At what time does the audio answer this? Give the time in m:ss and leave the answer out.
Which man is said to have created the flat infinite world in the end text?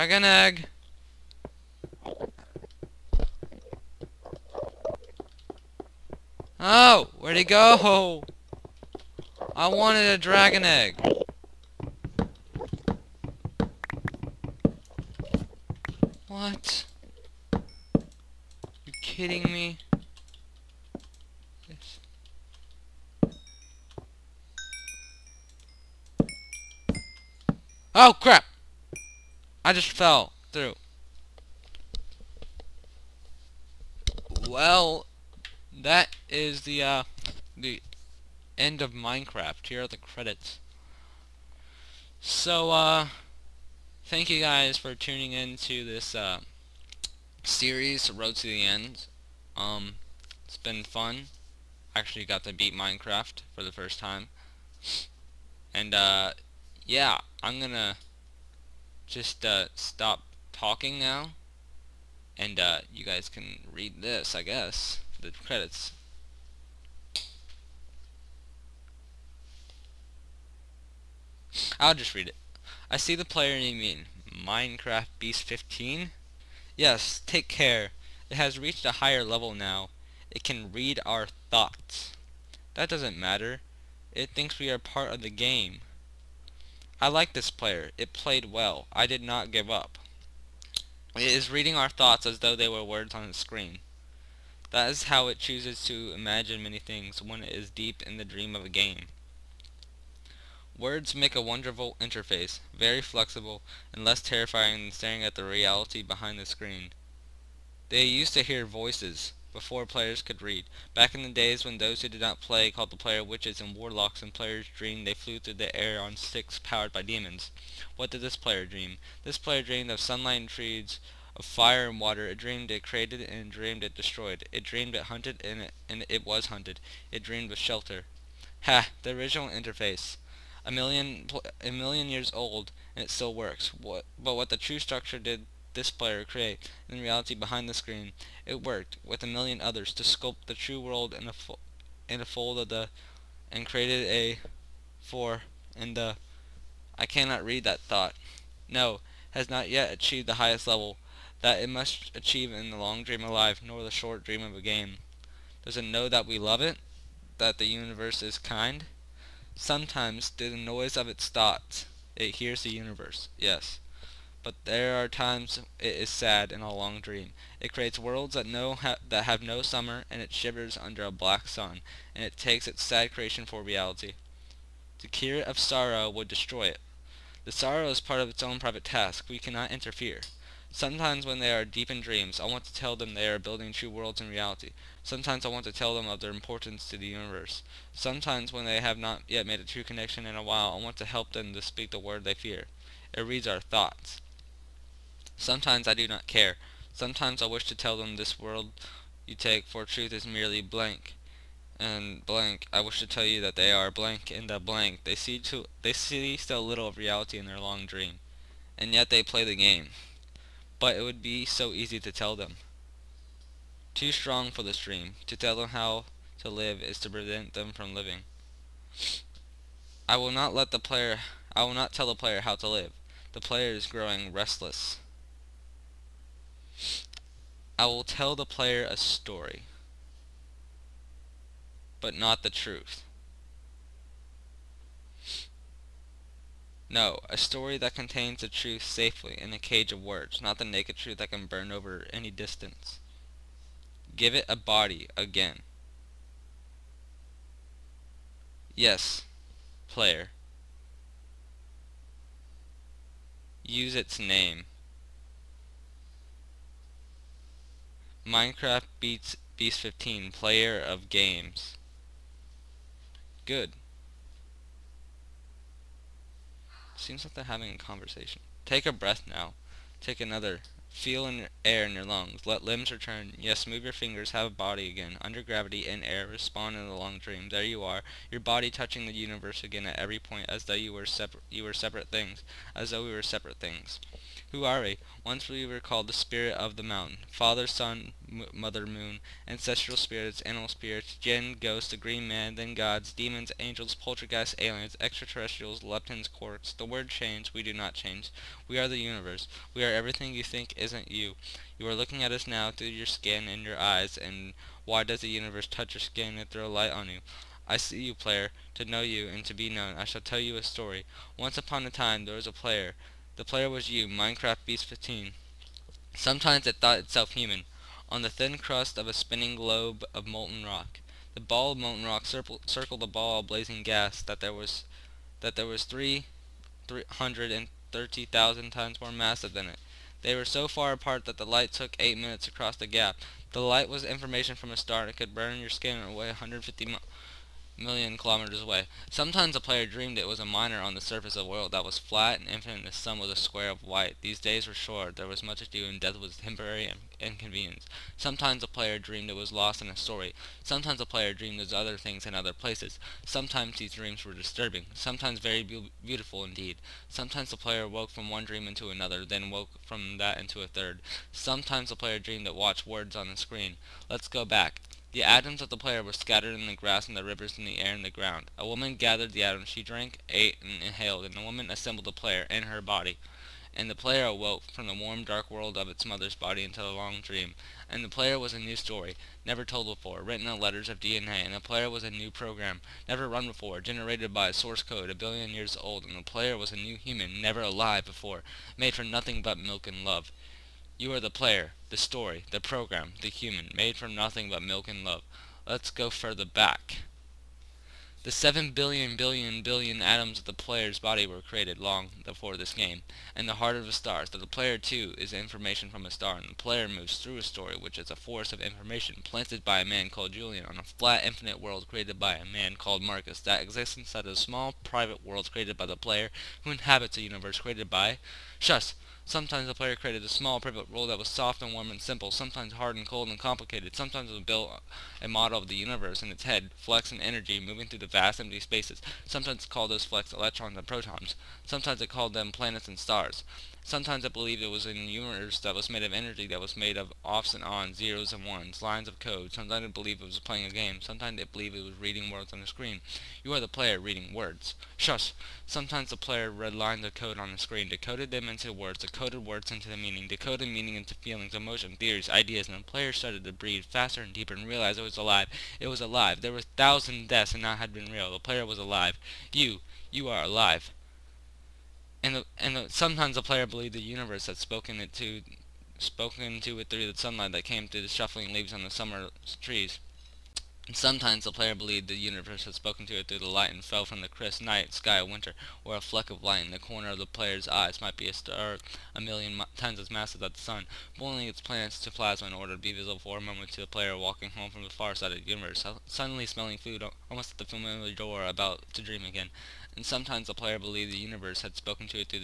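6:53.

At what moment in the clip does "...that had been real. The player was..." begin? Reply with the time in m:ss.
7:37.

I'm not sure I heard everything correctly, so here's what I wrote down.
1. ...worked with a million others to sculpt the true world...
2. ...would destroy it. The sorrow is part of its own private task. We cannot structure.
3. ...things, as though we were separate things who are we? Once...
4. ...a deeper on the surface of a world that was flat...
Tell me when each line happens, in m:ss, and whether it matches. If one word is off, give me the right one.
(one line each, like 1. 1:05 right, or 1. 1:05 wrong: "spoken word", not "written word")
1. 2:18 right
2. 2:56 wrong: "interfere", not "structure"
3. 4:42 right
4. 5:40 wrong: "miner", not "deeper".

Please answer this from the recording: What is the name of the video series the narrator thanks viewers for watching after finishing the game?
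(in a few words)
Road to the End.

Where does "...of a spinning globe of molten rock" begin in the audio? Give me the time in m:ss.
5:18.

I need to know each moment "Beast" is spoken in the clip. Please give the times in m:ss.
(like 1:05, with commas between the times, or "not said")
1:15, 4:19, 5:14.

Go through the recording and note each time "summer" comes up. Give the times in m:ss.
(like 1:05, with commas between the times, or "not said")
2:49, 7:48.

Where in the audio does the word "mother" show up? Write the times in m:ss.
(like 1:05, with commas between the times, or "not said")
4:48, 6:16.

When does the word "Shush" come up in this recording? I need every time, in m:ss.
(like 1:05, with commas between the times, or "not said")
6:58, 7:24.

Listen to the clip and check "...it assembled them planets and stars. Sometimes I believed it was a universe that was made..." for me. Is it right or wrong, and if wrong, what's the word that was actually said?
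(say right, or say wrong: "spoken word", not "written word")
wrong: "called", not "assembled".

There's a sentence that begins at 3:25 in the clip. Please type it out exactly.
They see too they see still little of reality in their long dream.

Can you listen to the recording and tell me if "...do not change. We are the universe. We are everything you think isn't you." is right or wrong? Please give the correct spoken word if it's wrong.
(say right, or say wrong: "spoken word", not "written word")
right.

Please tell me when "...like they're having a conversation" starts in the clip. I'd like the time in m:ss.
4:27.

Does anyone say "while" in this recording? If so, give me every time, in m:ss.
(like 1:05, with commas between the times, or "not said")
3:10.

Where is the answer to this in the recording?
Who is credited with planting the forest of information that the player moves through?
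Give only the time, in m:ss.
6:50.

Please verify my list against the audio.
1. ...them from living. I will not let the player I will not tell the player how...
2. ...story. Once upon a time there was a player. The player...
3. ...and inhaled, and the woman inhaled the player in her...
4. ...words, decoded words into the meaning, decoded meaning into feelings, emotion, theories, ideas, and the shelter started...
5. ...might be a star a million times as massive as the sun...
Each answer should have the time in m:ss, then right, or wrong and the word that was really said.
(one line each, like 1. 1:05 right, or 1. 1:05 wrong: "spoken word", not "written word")
1. 3:37 right
2. 5:10 right
3. 6:10 wrong: "assembled", not "inhaled"
4. 7:28 wrong: "player", not "shelter"
5. 7:58 right.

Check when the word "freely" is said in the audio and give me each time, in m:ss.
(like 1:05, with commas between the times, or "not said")
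not said.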